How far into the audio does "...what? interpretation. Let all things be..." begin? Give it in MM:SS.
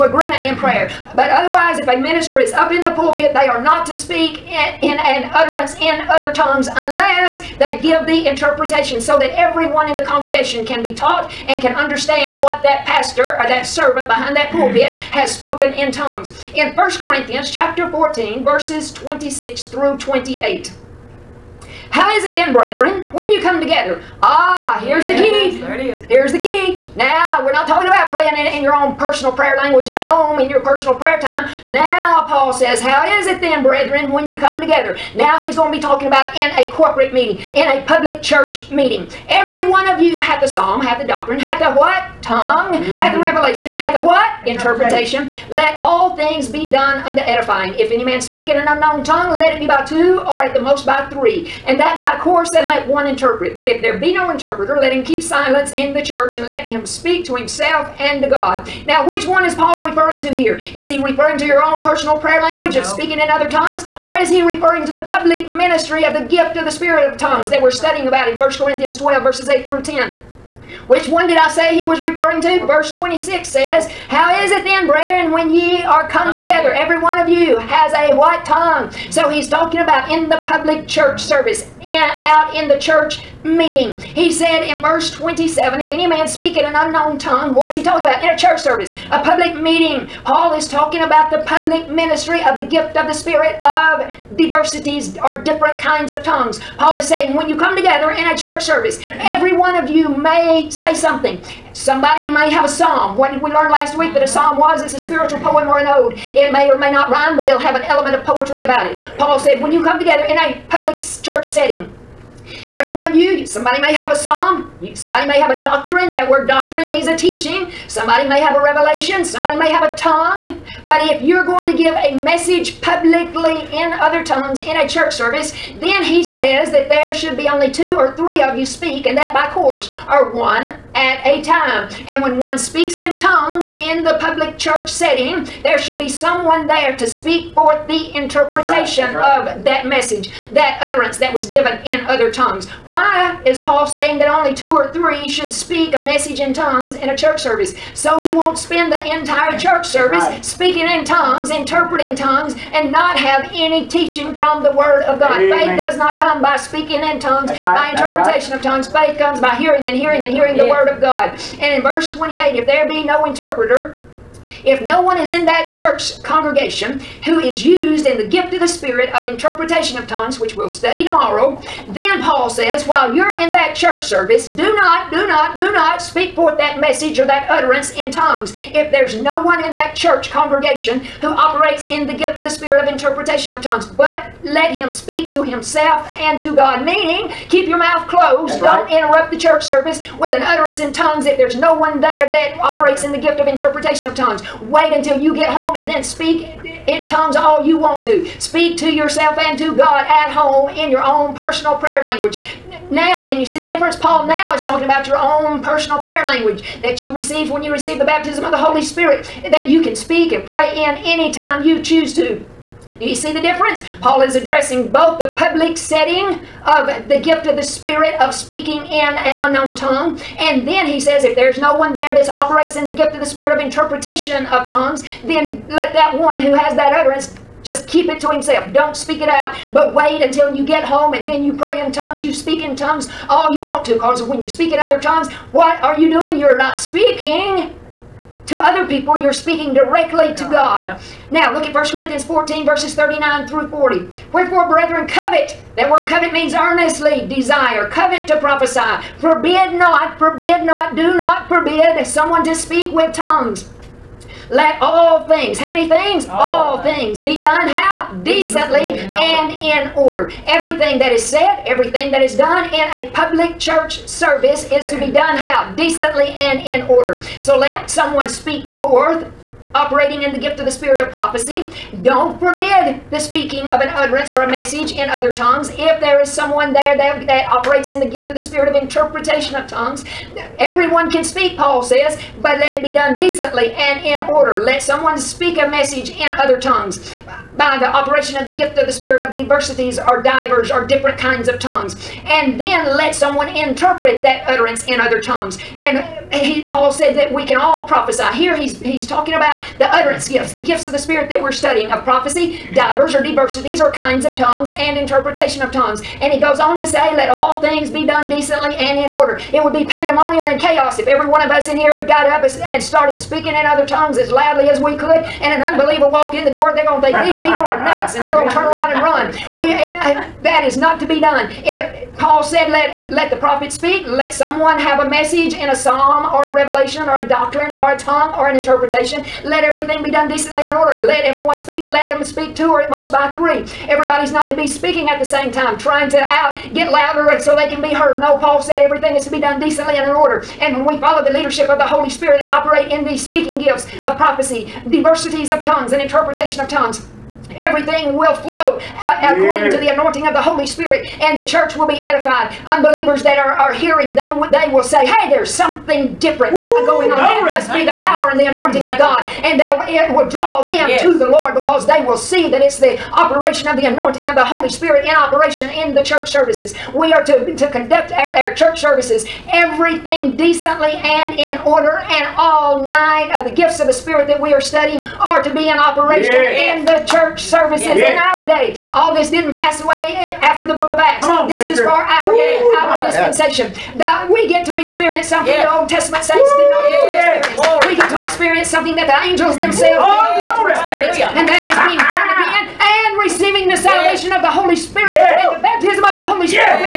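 00:44.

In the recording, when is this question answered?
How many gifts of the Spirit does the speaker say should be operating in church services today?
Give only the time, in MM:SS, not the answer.
06:12.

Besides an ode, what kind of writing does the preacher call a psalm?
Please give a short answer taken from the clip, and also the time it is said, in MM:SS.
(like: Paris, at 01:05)
a spiritual poem, at 01:44.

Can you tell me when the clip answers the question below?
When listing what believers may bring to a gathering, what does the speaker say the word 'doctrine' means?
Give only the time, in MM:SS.
01:57.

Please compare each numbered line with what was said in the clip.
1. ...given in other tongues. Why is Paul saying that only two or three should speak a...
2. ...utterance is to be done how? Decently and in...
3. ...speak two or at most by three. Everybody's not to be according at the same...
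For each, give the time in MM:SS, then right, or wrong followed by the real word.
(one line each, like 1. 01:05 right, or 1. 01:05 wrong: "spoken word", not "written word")
1. 02:21 right
2. 04:24 wrong: "service", not "utterance"
3. 05:32 wrong: "speaking", not "according".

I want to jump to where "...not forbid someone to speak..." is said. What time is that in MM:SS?
04:11.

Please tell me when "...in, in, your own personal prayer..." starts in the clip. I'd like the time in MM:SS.
00:28.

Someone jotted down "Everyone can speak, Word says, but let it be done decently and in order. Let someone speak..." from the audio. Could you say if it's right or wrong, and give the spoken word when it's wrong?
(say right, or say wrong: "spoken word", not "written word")
wrong: "Paul", not "Word".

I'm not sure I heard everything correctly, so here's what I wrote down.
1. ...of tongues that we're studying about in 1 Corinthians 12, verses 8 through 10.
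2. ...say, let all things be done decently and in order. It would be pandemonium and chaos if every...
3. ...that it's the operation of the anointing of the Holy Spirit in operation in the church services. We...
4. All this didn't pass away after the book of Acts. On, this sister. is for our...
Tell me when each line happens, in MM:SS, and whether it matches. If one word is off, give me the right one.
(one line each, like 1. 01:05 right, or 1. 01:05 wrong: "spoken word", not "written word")
1. 01:07 right
2. 05:06 right
3. 06:02 right
4. 06:18 right.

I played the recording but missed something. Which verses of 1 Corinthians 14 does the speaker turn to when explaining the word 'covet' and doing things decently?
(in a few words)
39 through 40.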